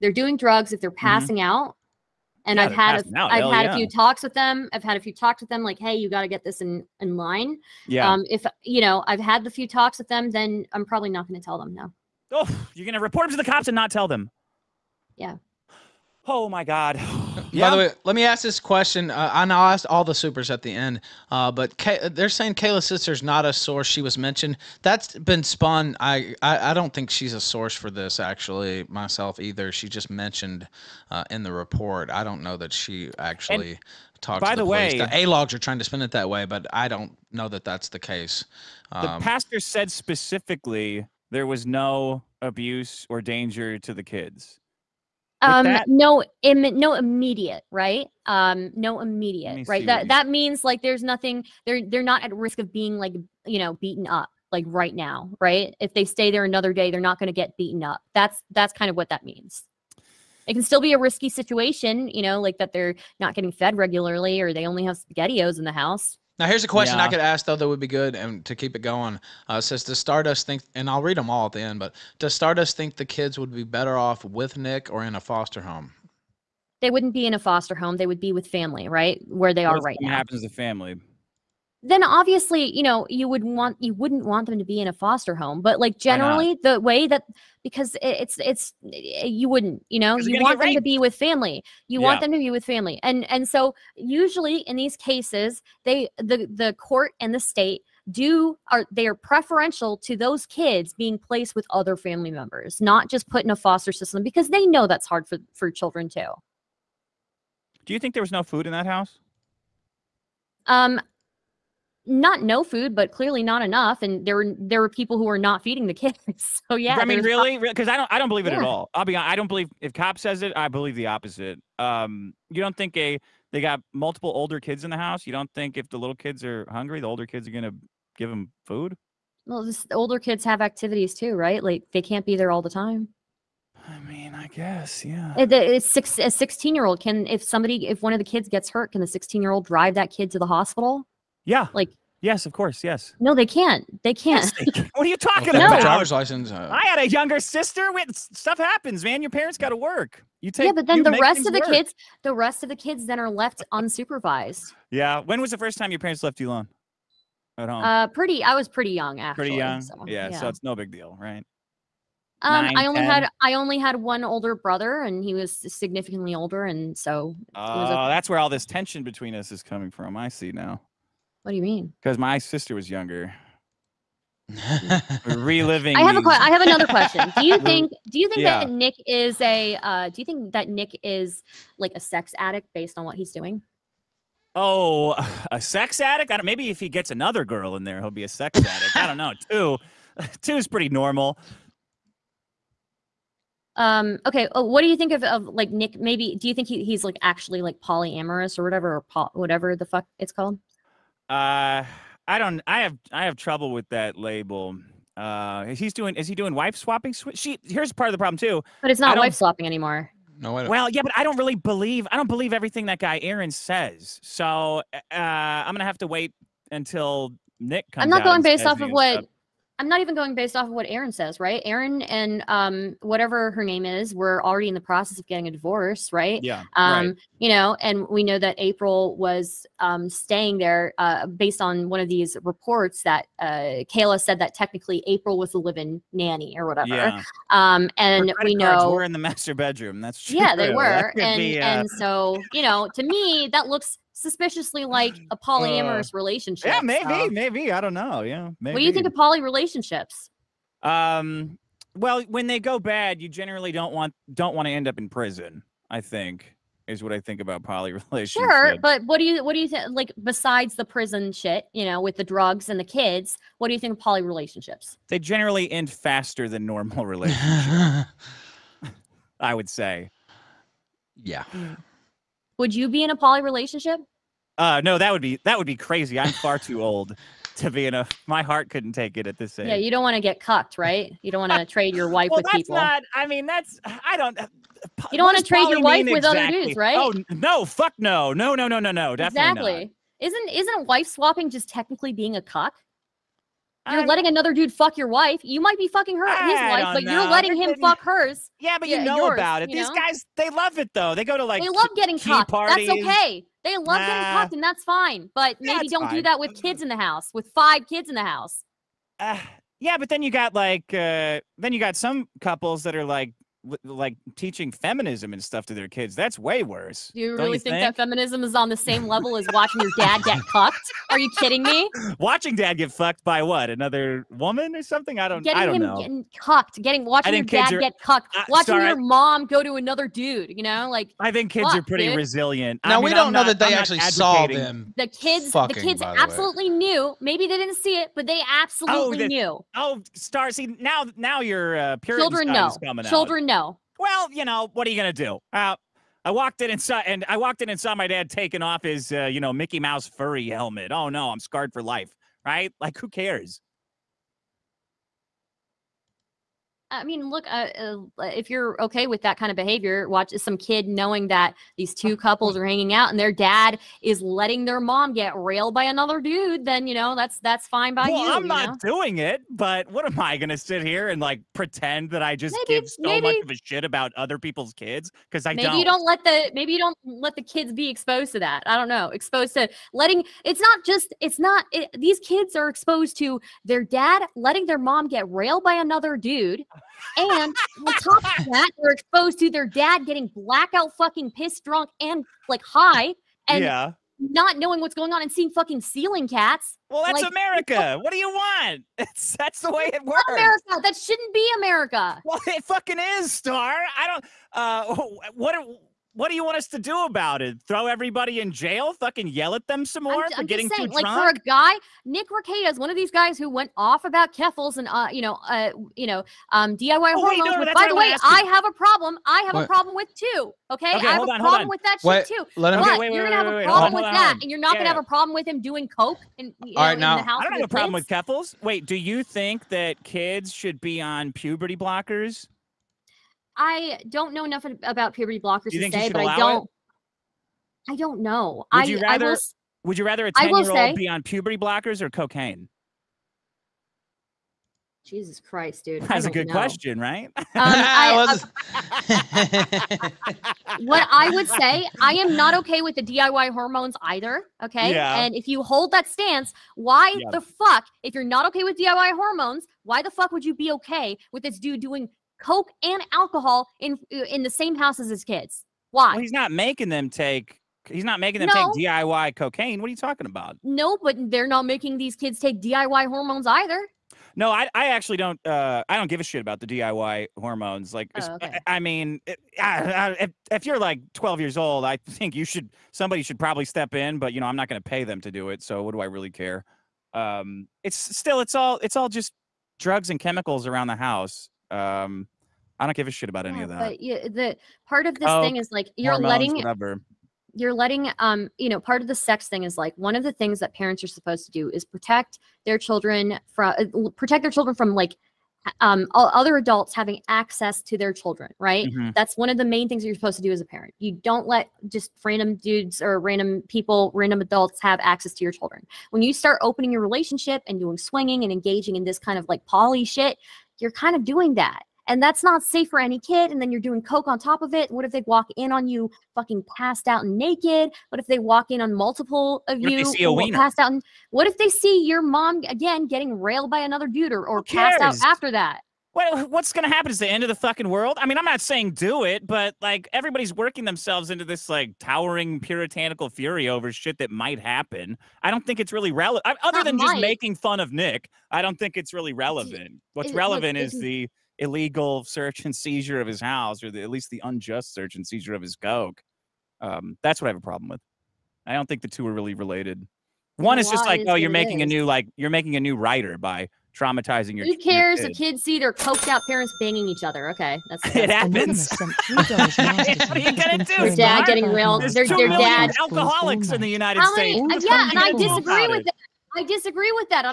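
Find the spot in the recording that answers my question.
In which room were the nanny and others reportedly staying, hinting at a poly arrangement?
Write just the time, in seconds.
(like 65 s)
239 s.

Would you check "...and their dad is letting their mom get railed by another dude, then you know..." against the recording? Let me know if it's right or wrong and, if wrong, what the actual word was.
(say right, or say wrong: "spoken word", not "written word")
right.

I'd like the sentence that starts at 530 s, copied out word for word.
And, what if they see your mom again getting railed by another dude or, or passed out after that?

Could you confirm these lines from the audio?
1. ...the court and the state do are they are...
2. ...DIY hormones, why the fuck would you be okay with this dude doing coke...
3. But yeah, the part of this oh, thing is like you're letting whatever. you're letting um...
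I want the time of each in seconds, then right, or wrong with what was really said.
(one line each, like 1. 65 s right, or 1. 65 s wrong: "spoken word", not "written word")
1. 96 s right
2. 458 s right
3. 493 s right.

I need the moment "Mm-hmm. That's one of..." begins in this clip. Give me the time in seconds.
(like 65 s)
508 s.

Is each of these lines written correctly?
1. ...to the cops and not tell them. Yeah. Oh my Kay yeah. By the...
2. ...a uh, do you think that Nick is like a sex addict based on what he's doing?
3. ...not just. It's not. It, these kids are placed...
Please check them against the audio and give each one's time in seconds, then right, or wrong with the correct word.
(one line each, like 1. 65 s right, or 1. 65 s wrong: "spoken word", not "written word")
1. 13 s wrong: "God", not "Kay"
2. 179 s right
3. 380 s wrong: "exposed", not "placed".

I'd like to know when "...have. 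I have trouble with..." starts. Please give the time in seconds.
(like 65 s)
202 s.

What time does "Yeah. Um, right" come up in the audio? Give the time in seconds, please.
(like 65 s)
226 s.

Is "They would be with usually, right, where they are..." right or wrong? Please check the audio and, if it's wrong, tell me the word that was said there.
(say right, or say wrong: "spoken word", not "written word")
wrong: "family", not "usually".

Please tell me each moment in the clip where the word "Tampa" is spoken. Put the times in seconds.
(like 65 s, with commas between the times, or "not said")
not said.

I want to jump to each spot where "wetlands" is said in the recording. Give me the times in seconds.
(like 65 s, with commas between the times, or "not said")
not said.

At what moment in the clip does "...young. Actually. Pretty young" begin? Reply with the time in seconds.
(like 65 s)
158 s.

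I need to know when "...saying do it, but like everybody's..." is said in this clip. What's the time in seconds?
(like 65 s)
538 s.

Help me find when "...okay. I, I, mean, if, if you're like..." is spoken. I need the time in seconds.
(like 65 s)
478 s.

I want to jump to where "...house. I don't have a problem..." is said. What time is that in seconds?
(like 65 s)
427 s.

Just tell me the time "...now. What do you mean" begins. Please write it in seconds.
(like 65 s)
170 s.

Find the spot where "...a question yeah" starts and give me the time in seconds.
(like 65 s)
66 s.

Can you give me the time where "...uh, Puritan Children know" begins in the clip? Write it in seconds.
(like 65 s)
341 s.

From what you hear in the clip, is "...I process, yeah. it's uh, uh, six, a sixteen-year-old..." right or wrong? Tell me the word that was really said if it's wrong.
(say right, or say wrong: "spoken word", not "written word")
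wrong: "guess", not "process".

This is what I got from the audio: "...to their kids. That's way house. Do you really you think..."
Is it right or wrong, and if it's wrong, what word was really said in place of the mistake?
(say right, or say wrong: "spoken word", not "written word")
wrong: "worse", not "house".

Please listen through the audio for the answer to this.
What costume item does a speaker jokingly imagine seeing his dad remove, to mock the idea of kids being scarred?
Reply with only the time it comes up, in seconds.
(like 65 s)
349 s.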